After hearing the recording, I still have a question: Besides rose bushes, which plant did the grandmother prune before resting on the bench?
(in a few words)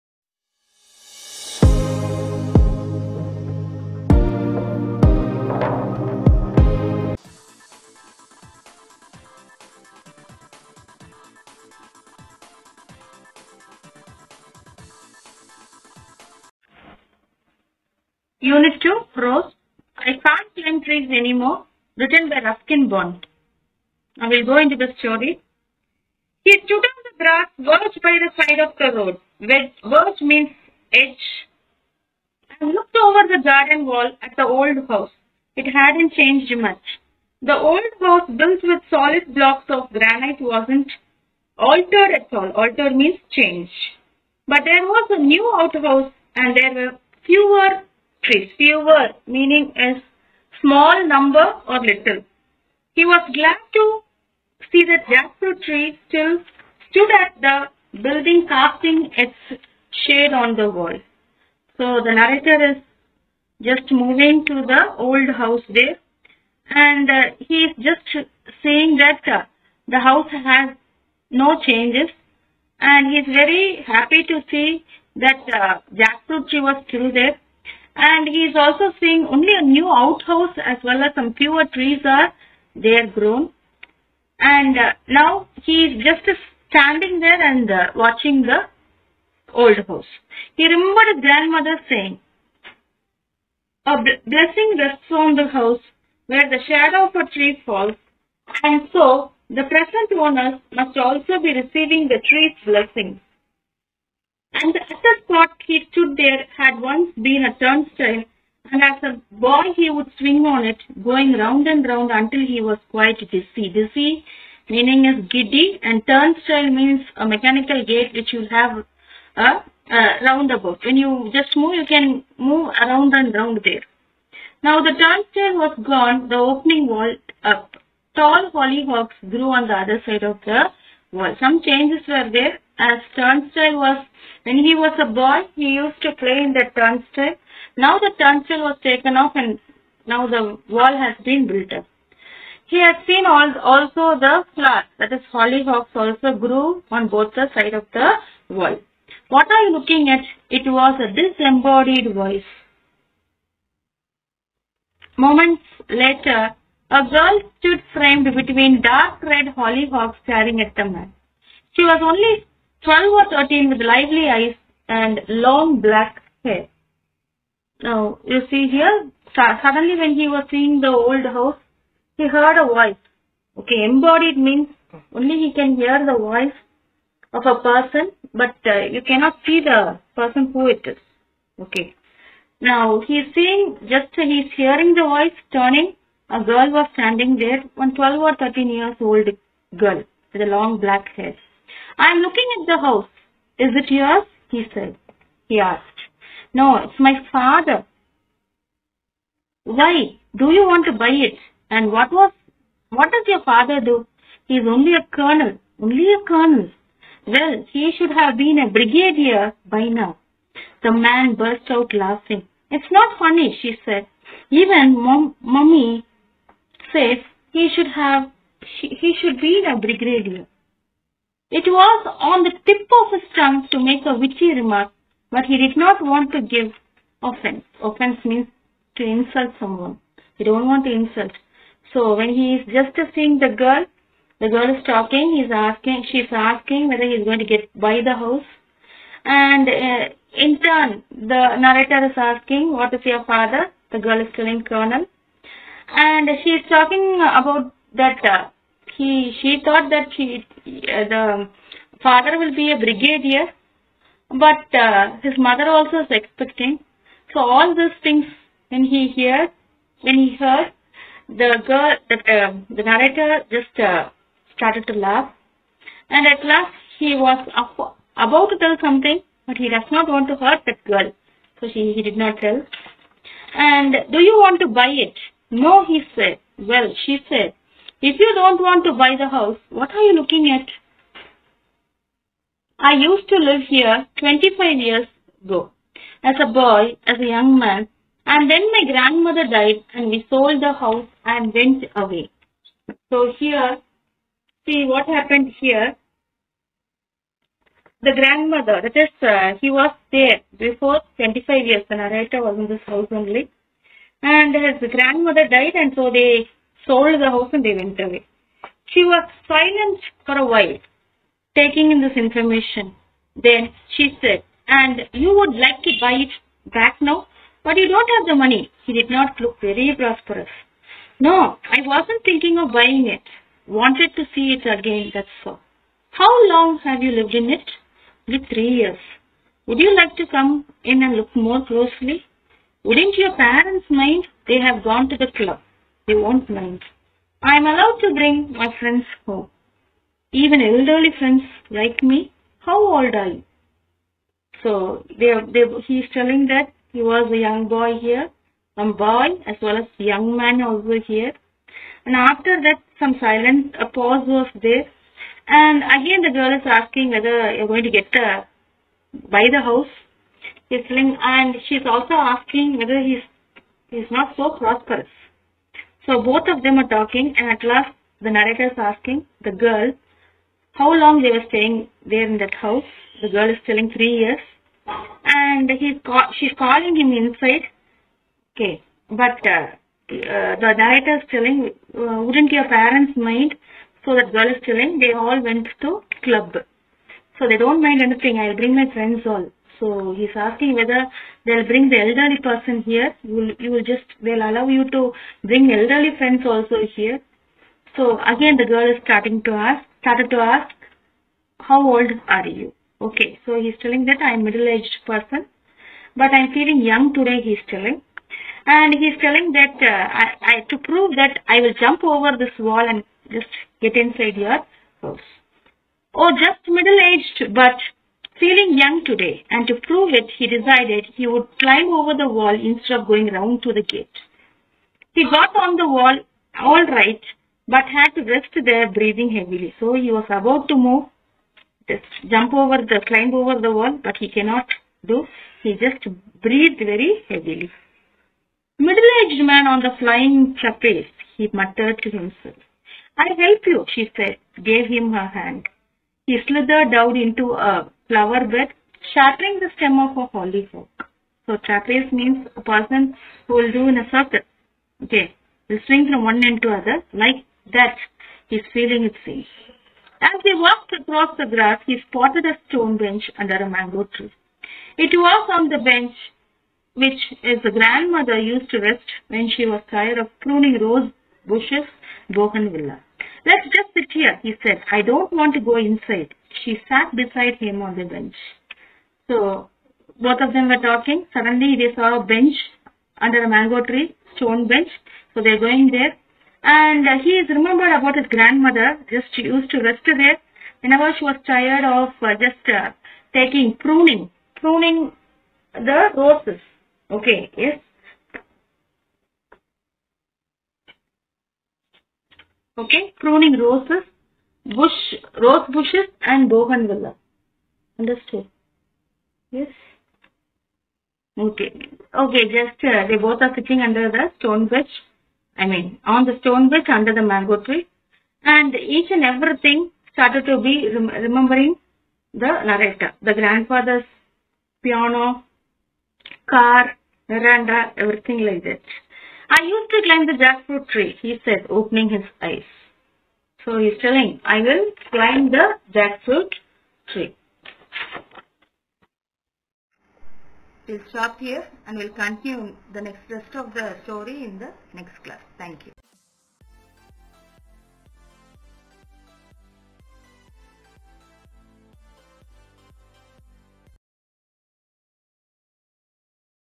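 Bougainvillea.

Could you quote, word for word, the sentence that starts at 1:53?
Dizzy meaning is giddy, and turnstile means a mechanical gate which you have a, uh, a uh, roundabout.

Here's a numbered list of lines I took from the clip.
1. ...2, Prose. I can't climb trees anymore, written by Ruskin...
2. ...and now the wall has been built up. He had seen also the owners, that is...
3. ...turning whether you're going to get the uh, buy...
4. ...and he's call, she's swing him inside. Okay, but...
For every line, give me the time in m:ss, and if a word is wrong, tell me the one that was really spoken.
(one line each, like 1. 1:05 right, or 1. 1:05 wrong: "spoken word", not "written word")
1. 0:18 right
2. 2:19 wrong: "flowers", not "owners"
3. 5:56 wrong: "asking", not "turning"
4. 6:15 wrong: "calling", not "swing".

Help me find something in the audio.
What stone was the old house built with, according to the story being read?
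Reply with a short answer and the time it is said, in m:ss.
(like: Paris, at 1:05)
Granite, at 0:39.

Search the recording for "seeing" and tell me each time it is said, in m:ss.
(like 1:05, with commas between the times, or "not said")
1:18, 2:50, 3:03, 3:53.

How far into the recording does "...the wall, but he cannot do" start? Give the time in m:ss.
7:13.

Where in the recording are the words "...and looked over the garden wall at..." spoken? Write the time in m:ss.
0:32.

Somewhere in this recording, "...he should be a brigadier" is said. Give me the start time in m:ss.
3:38.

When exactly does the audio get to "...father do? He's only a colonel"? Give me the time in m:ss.
3:23.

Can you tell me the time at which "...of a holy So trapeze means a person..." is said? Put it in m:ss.
7:30.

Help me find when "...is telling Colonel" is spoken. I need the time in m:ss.
4:04.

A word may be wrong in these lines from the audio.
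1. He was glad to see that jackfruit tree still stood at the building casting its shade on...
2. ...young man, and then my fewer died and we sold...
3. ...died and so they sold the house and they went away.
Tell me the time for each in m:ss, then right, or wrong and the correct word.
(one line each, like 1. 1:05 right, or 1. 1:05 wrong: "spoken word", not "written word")
1. 0:52 right
2. 4:47 wrong: "grandmother", not "fewer"
3. 5:05 right.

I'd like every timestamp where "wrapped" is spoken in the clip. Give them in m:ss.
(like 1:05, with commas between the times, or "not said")
not said.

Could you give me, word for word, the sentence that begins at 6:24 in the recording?
So that girl is telling, they all went to club.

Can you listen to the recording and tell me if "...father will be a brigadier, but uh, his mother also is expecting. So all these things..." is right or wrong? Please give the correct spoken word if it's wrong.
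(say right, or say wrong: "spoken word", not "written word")
right.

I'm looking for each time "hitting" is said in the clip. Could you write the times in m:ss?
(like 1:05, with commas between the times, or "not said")
not said.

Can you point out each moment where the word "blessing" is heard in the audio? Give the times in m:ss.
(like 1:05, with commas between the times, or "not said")
1:33, 1:42.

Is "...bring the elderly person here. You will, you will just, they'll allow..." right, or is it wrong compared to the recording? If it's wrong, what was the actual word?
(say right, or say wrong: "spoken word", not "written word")
right.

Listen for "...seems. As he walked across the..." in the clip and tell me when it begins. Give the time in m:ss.
7:39.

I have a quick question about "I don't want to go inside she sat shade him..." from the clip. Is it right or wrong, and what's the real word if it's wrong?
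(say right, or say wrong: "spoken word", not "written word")
wrong: "beside", not "shade".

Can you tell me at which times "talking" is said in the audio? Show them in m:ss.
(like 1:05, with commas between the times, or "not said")
3:54, 4:06, 6:06, 8:00.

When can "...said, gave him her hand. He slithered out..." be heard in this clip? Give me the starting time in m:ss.
7:24.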